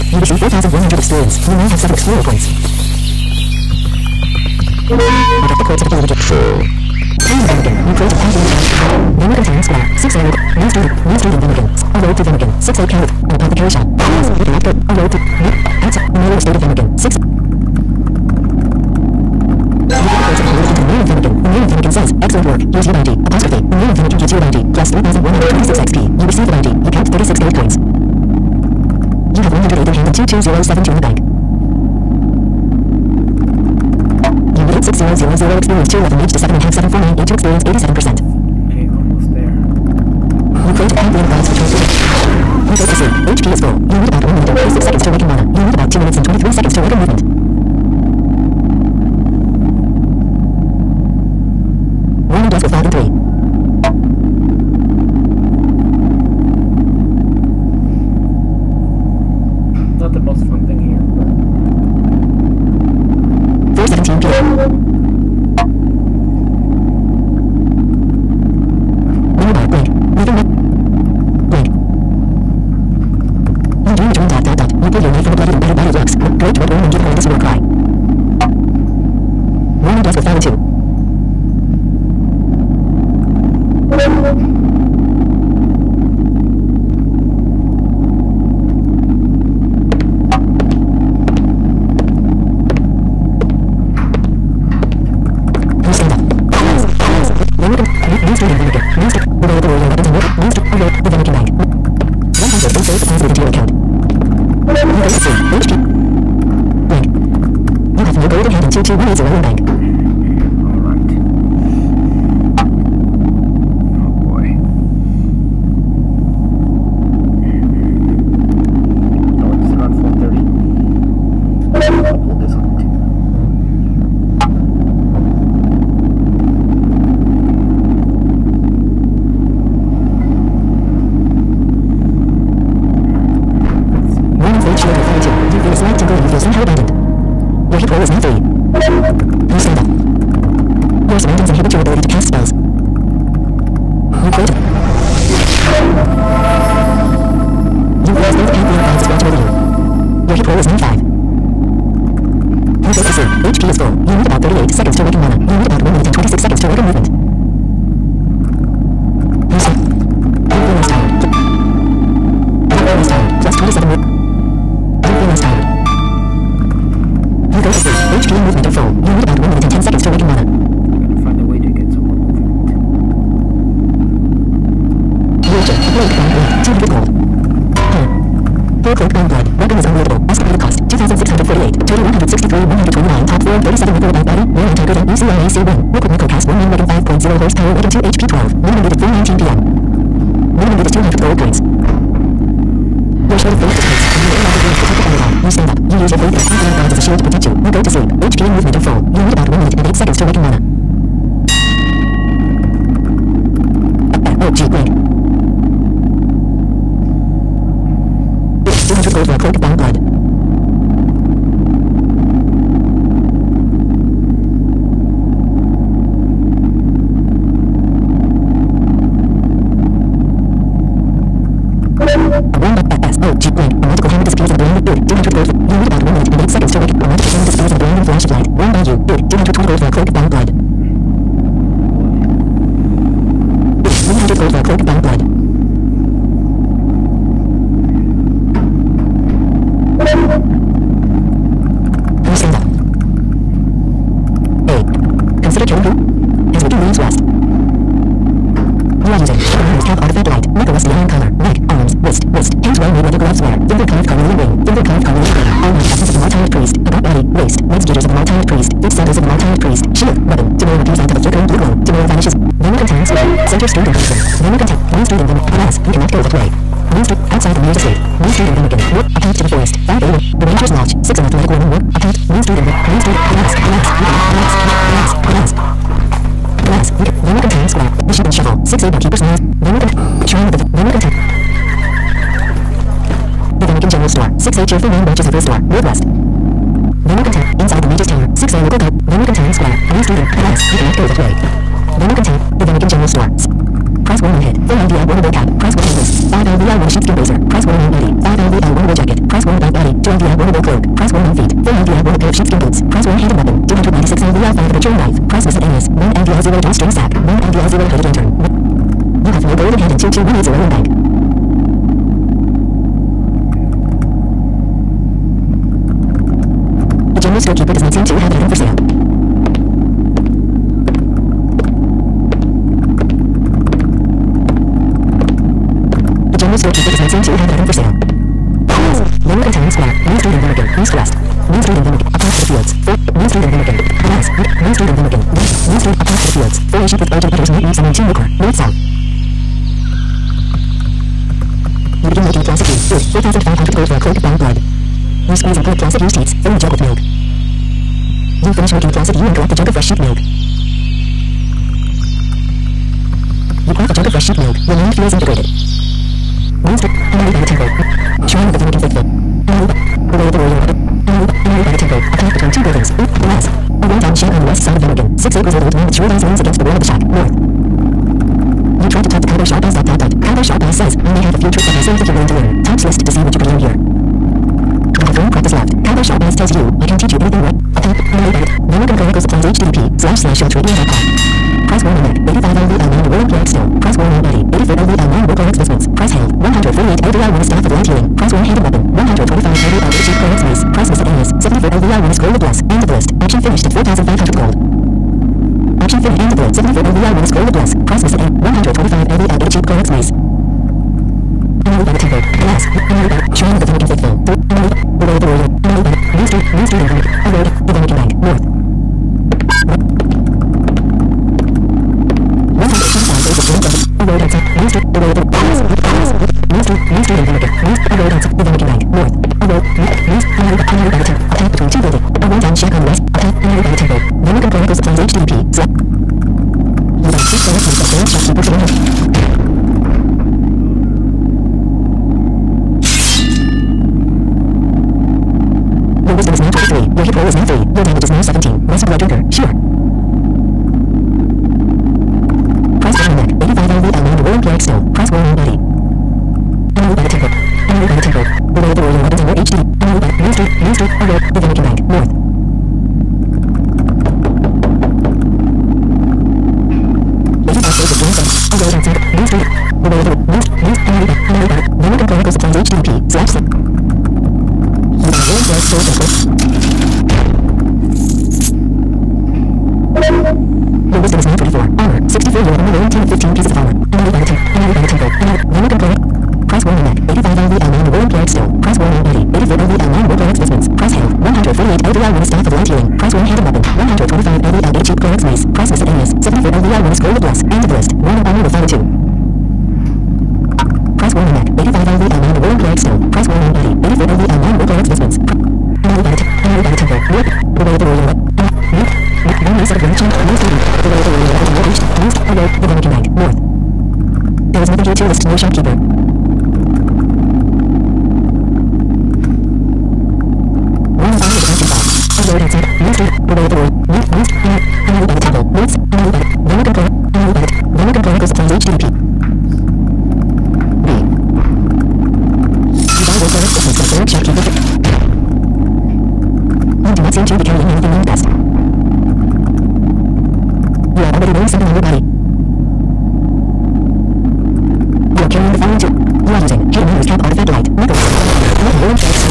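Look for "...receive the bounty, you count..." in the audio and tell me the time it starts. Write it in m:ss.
0:26.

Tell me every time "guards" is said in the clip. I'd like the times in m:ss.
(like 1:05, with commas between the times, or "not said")
3:16.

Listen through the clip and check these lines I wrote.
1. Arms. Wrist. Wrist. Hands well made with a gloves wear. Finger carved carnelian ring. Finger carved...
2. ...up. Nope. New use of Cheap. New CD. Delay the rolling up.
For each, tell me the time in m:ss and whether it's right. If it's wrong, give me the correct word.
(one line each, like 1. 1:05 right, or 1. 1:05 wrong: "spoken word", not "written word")
1. 4:11 right
2. 8:18 wrong: "Ranchon", not "Cheap".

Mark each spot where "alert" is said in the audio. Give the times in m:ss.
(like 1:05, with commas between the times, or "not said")
3:47, 6:22, 7:31.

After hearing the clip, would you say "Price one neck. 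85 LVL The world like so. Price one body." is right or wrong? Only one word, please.
right.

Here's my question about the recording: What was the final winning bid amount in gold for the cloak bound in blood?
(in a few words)
220.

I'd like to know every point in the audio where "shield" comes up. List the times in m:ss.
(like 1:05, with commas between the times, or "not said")
3:16, 4:19.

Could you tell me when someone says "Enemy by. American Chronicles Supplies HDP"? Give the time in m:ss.
7:41.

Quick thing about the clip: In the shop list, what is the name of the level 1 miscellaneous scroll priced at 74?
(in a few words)
Scroll of Bless.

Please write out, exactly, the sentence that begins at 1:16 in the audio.
Great to a woman give her this will cry.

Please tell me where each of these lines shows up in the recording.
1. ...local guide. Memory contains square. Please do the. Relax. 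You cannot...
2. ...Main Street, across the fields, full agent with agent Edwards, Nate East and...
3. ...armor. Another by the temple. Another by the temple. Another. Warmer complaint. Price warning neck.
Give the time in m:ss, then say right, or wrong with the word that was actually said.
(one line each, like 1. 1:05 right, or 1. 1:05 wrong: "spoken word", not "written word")
1. 4:48 right
2. 5:35 right
3. 7:53 right.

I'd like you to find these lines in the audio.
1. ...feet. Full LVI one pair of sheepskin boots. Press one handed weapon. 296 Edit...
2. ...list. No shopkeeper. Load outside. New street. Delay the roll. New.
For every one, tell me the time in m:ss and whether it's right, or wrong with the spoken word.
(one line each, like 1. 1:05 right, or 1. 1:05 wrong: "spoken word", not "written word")
1. 5:01 wrong: "LVI", not "Edit"
2. 8:25 right.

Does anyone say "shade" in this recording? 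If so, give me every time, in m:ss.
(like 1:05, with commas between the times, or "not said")
not said.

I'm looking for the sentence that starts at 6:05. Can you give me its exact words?
Six acres of old land tree lines against the wall of the shack.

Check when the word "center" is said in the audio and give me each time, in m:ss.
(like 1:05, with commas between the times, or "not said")
2:16, 4:23.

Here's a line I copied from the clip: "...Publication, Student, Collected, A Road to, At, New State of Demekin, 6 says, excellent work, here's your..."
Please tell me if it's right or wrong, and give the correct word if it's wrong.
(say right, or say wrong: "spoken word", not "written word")
wrong: "Please", not "Student".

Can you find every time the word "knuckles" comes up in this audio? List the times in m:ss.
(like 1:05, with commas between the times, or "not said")
8:57.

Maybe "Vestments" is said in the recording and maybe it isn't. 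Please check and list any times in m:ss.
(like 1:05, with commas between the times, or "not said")
8:00.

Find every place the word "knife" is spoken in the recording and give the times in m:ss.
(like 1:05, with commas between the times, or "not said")
5:04.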